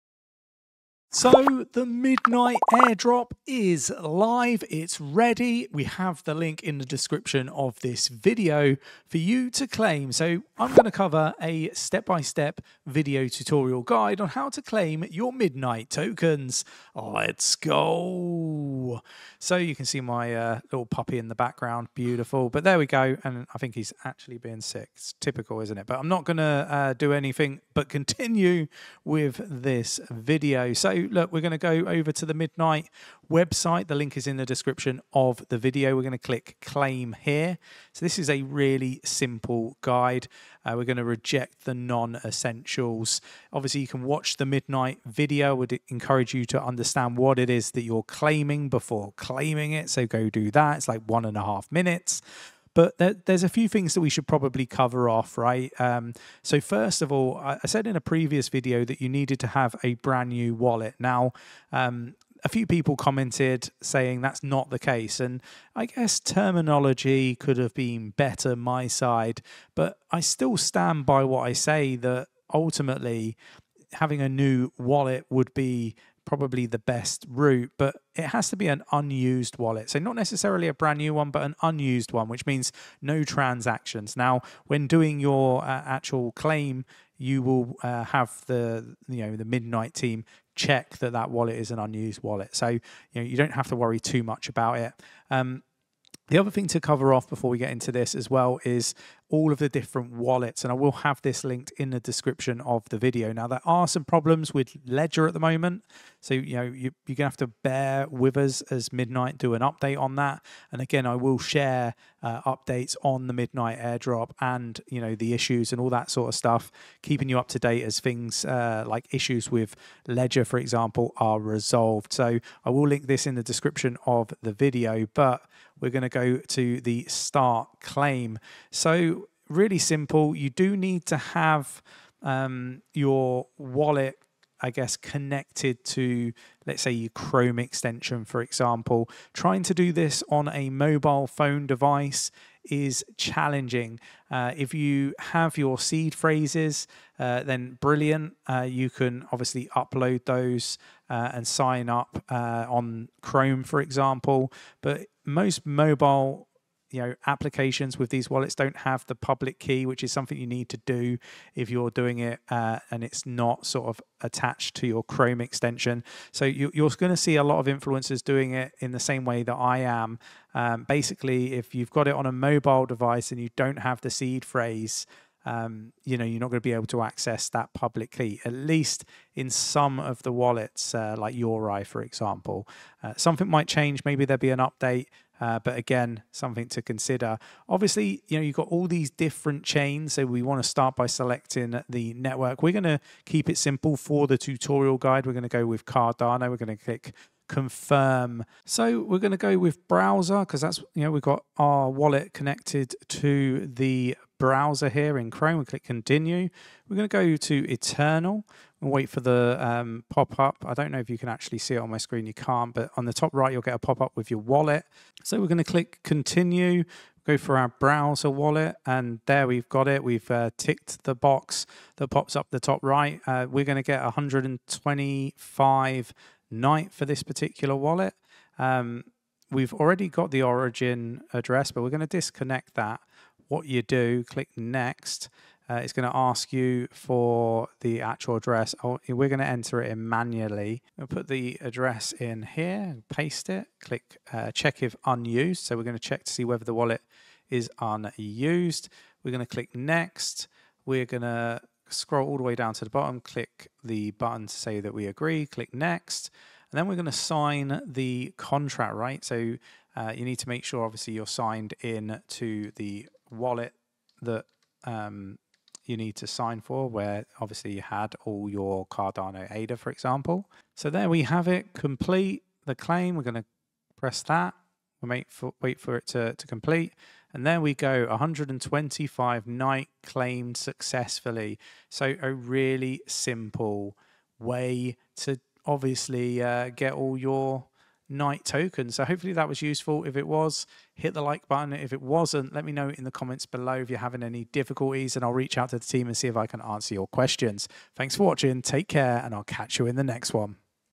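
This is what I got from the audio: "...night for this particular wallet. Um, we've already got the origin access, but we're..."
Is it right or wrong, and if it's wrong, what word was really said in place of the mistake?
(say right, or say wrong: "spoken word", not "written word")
wrong: "address", not "access".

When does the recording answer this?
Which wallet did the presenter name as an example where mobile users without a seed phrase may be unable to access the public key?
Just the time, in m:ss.
3:01.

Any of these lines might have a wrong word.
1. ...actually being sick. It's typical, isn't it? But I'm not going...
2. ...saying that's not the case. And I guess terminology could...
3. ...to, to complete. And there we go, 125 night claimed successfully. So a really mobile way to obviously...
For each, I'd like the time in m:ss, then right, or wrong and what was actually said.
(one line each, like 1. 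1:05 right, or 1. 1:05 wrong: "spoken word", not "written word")
1. 0:24 right
2. 1:03 right
3. 4:36 wrong: "simple", not "mobile".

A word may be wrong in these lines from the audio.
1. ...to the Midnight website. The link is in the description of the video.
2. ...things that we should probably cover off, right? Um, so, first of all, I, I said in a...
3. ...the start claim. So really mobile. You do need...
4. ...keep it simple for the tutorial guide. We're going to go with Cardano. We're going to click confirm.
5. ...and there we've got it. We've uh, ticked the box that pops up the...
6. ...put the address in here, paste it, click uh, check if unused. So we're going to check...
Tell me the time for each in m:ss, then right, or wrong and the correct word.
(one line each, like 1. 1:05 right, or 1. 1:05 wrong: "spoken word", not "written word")
1. 0:32 right
2. 0:53 right
3. 2:06 wrong: "simple", not "mobile"
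4. 3:13 right
5. 3:38 right
6. 4:01 right.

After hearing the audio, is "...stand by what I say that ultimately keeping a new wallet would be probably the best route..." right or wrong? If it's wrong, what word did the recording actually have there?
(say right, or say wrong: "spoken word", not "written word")
wrong: "having", not "keeping".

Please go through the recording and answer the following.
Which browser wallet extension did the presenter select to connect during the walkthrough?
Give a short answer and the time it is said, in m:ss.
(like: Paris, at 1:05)
Eternl, at 3:27.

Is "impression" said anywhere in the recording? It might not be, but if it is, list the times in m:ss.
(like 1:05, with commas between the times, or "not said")
not said.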